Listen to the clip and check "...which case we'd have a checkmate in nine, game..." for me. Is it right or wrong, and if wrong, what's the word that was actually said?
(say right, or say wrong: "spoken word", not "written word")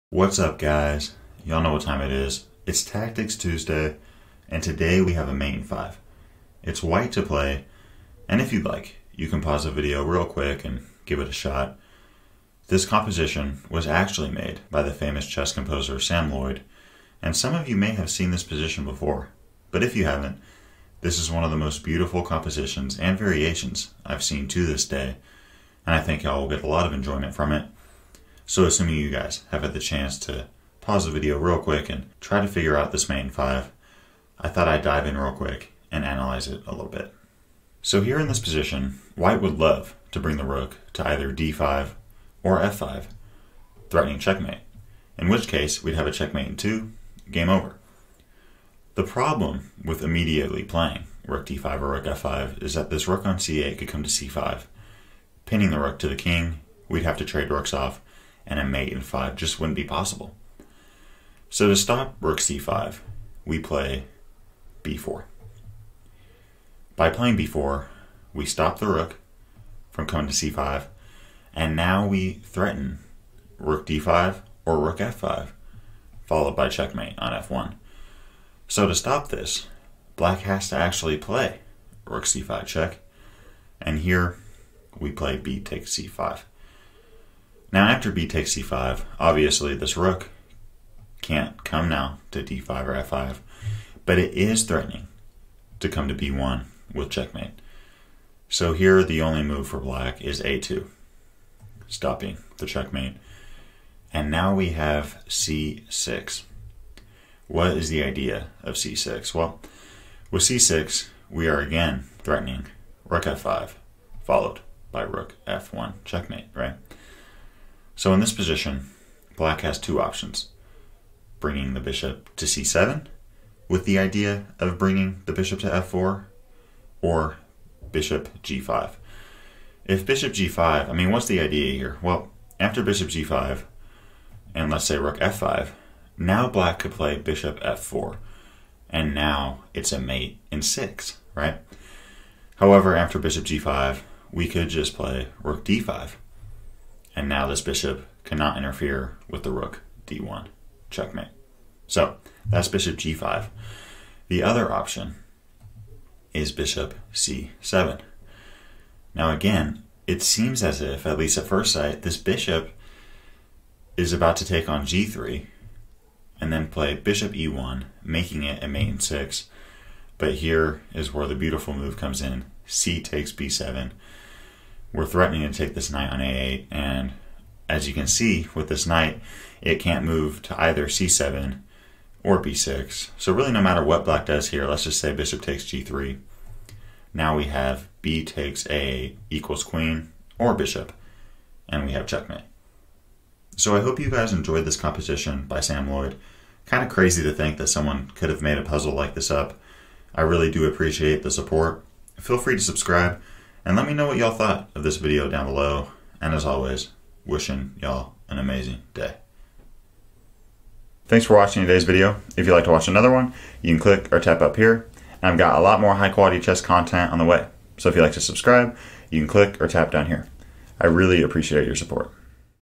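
wrong: "two", not "nine".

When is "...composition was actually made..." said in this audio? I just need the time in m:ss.
0:12.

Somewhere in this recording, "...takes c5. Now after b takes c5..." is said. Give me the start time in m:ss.
1:25.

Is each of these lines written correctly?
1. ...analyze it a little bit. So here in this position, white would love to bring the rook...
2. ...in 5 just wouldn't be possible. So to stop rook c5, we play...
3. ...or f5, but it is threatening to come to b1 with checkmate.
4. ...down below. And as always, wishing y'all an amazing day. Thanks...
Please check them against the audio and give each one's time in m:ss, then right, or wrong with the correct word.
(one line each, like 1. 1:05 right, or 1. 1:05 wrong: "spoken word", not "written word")
1. 0:36 right
2. 0:58 right
3. 1:32 right
4. 3:25 right.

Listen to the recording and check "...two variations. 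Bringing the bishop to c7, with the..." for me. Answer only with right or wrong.
wrong.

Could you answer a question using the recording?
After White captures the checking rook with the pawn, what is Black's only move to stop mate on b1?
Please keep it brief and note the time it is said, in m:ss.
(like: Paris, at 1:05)
a2, at 1:40.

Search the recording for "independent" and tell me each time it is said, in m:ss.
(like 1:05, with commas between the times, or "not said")
not said.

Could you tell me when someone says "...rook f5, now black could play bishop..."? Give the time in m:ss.
2:14.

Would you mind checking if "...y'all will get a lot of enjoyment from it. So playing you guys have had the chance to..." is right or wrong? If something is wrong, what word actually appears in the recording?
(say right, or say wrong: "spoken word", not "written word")
wrong: "assuming", not "playing".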